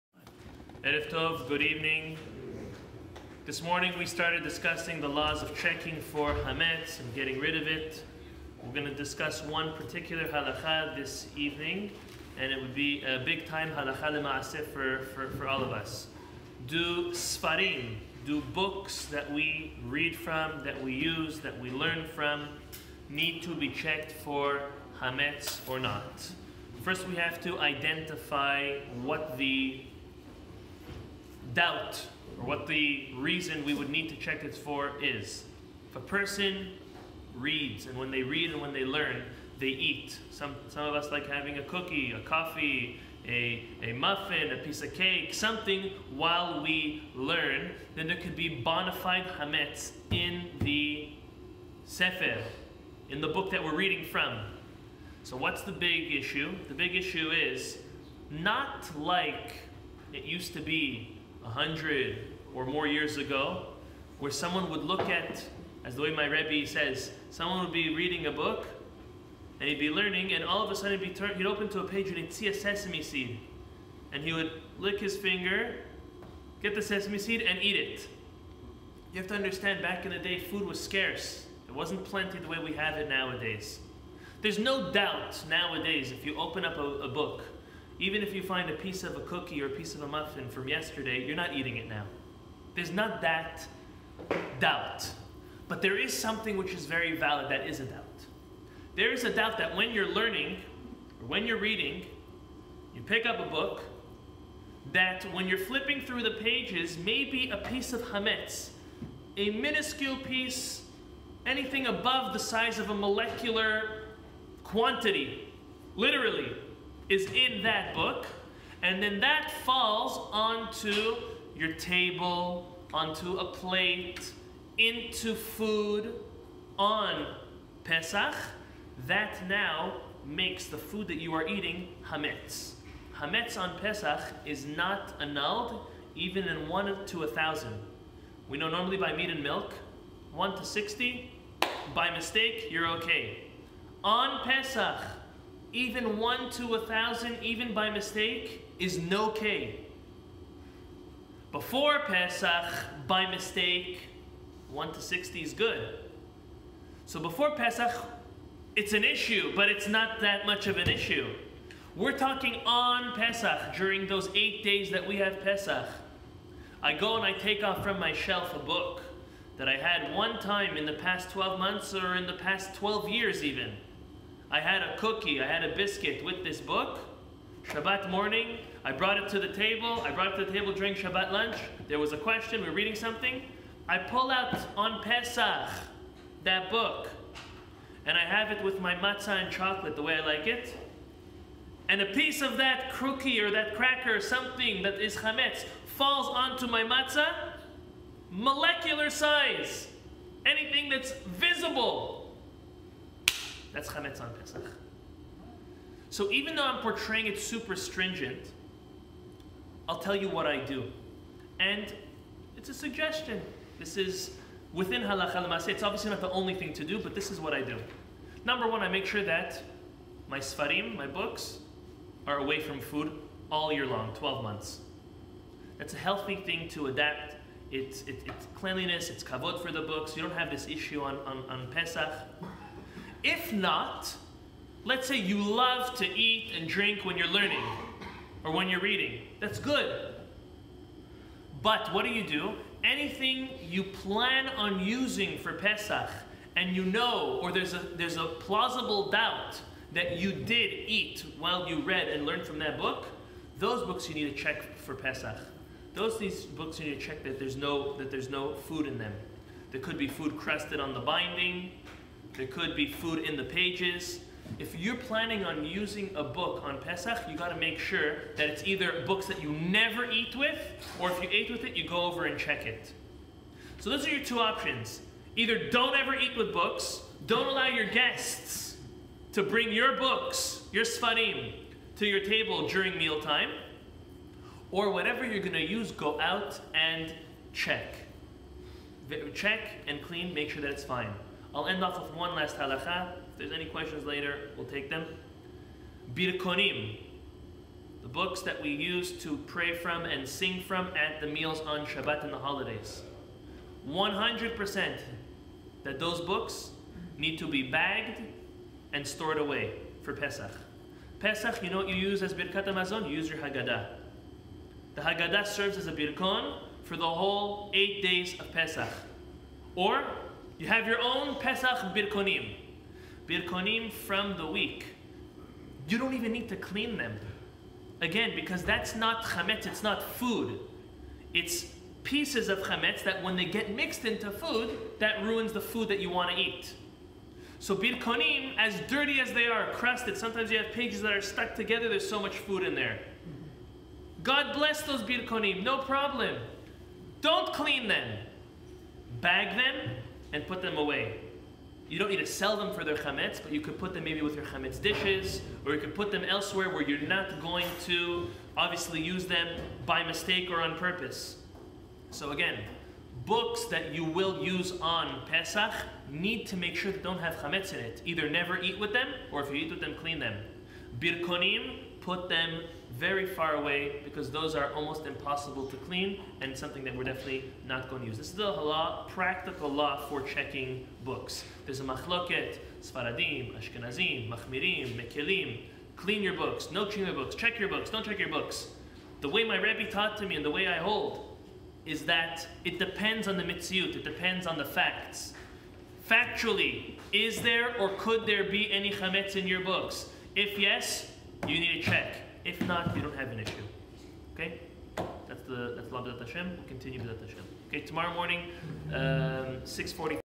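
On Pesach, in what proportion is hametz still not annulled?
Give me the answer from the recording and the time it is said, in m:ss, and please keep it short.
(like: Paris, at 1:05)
1 to 1,000, at 2:16.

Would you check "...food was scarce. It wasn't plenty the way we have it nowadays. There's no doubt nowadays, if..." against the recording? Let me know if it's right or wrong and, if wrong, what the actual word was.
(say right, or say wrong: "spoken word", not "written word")
right.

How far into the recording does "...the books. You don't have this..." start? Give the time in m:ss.
3:49.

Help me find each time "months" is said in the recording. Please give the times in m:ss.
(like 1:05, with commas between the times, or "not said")
2:51, 3:44.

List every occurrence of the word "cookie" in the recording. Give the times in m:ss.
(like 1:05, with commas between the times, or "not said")
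0:41, 1:29, 2:54.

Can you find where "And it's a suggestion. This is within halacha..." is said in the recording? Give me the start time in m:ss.
3:31.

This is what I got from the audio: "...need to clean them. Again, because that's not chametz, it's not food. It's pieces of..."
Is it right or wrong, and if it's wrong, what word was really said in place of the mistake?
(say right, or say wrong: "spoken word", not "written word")
right.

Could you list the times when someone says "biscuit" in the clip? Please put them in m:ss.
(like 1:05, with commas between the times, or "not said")
2:55.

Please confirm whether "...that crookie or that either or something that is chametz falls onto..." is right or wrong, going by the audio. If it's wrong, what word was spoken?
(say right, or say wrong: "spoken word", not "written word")
wrong: "cracker", not "either".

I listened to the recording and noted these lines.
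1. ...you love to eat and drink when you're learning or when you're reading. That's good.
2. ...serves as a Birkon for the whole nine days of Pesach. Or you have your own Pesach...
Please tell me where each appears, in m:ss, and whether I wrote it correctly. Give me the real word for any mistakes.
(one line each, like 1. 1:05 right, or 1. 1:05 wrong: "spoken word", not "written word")
1. 3:55 right
2. 5:15 wrong: "eight", not "nine".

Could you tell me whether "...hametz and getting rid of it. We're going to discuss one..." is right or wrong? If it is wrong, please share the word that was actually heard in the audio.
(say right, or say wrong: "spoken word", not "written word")
right.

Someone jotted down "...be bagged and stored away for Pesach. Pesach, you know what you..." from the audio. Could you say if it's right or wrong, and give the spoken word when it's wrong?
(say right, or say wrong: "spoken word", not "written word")
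right.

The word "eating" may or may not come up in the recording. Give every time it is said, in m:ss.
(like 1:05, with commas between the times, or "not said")
1:31, 2:11.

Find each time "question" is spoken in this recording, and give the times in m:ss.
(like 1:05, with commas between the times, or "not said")
3:02, 4:53.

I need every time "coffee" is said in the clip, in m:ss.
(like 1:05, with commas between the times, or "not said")
0:42.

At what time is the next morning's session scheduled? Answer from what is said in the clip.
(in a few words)
6:40.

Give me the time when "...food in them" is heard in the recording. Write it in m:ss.
4:18.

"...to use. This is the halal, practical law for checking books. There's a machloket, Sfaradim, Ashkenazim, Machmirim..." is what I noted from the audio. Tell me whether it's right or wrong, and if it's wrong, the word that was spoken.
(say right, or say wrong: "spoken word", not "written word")
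right.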